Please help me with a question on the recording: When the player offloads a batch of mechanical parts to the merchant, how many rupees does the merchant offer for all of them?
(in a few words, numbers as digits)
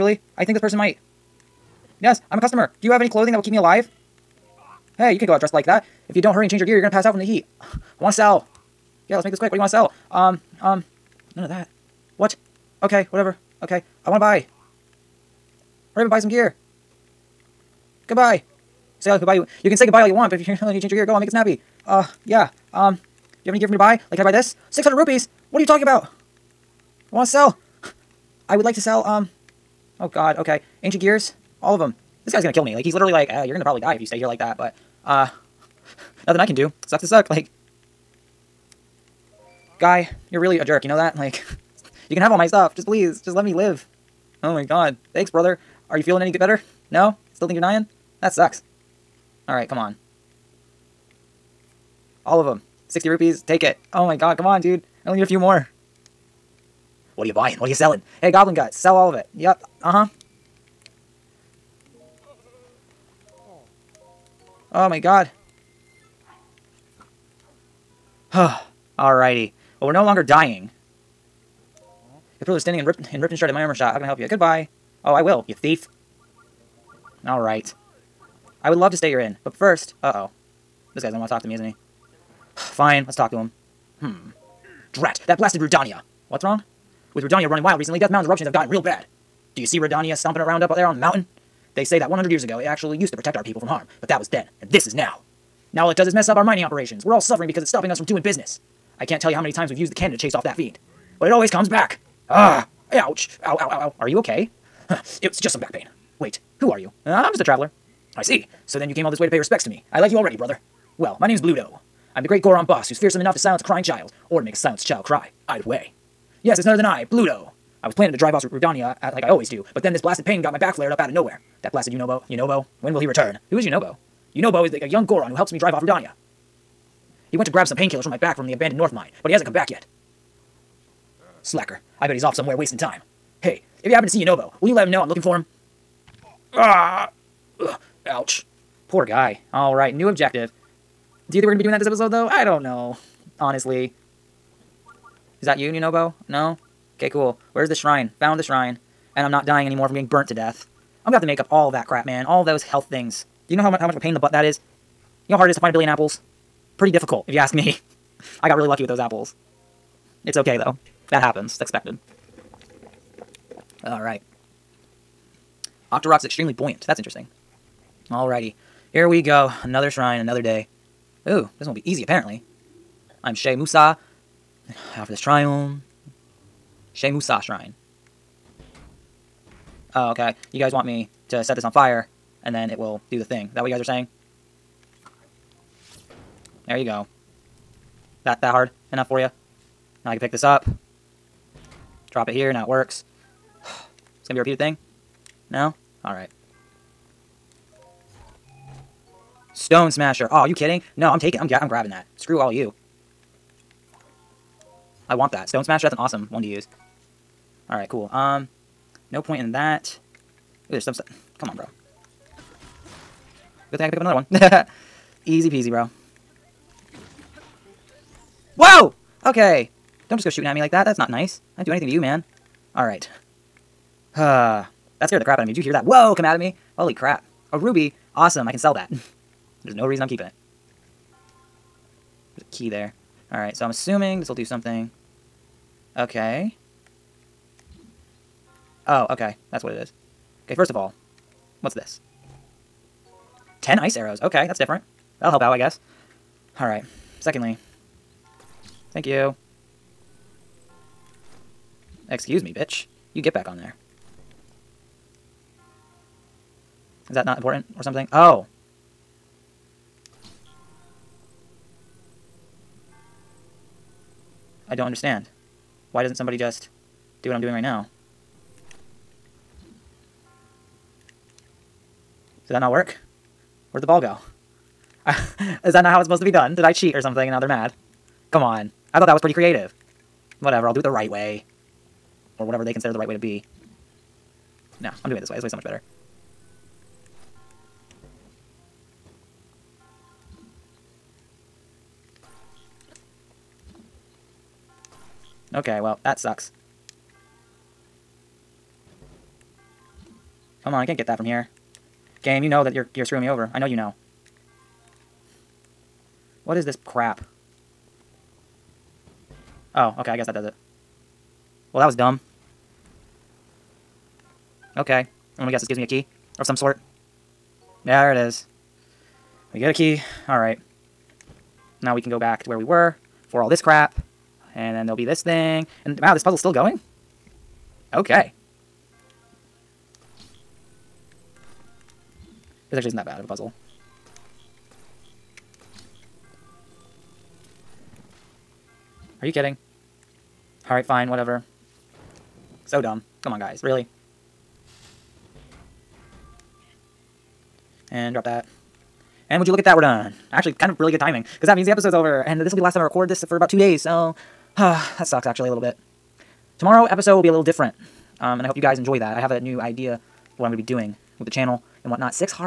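60.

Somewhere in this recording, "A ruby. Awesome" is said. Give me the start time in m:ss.
3:47.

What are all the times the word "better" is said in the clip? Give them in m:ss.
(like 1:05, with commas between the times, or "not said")
0:46, 4:45.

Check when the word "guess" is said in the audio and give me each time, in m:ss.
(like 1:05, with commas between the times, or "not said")
4:05, 5:10, 5:15.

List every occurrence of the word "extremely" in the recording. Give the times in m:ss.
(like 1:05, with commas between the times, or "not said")
2:46.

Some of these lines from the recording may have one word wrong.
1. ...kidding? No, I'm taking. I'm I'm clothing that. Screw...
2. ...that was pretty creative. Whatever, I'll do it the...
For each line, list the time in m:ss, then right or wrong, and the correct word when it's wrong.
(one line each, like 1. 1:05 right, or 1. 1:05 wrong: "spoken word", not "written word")
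1. 3:20 wrong: "grabbing", not "clothing"
2. 4:39 right.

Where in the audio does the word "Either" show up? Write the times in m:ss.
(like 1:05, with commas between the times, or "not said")
1:55.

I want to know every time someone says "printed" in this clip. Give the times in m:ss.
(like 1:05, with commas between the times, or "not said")
not said.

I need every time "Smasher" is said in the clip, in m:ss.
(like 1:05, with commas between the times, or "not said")
3:19, 3:25.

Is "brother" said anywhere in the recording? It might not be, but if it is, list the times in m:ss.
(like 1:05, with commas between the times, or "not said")
0:45, 1:50.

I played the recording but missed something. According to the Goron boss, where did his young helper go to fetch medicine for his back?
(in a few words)
abandoned North Mine.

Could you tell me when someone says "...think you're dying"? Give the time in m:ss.
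0:47.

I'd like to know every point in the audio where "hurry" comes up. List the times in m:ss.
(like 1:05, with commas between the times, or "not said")
0:06, 0:15.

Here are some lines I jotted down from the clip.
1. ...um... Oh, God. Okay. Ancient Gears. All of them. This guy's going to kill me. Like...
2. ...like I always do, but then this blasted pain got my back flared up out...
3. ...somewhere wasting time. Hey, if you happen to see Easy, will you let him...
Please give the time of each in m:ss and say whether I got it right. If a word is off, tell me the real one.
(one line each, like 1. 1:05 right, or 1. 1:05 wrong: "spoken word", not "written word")
1. 0:29 right
2. 1:59 right
3. 2:12 wrong: "Yunobo", not "Easy".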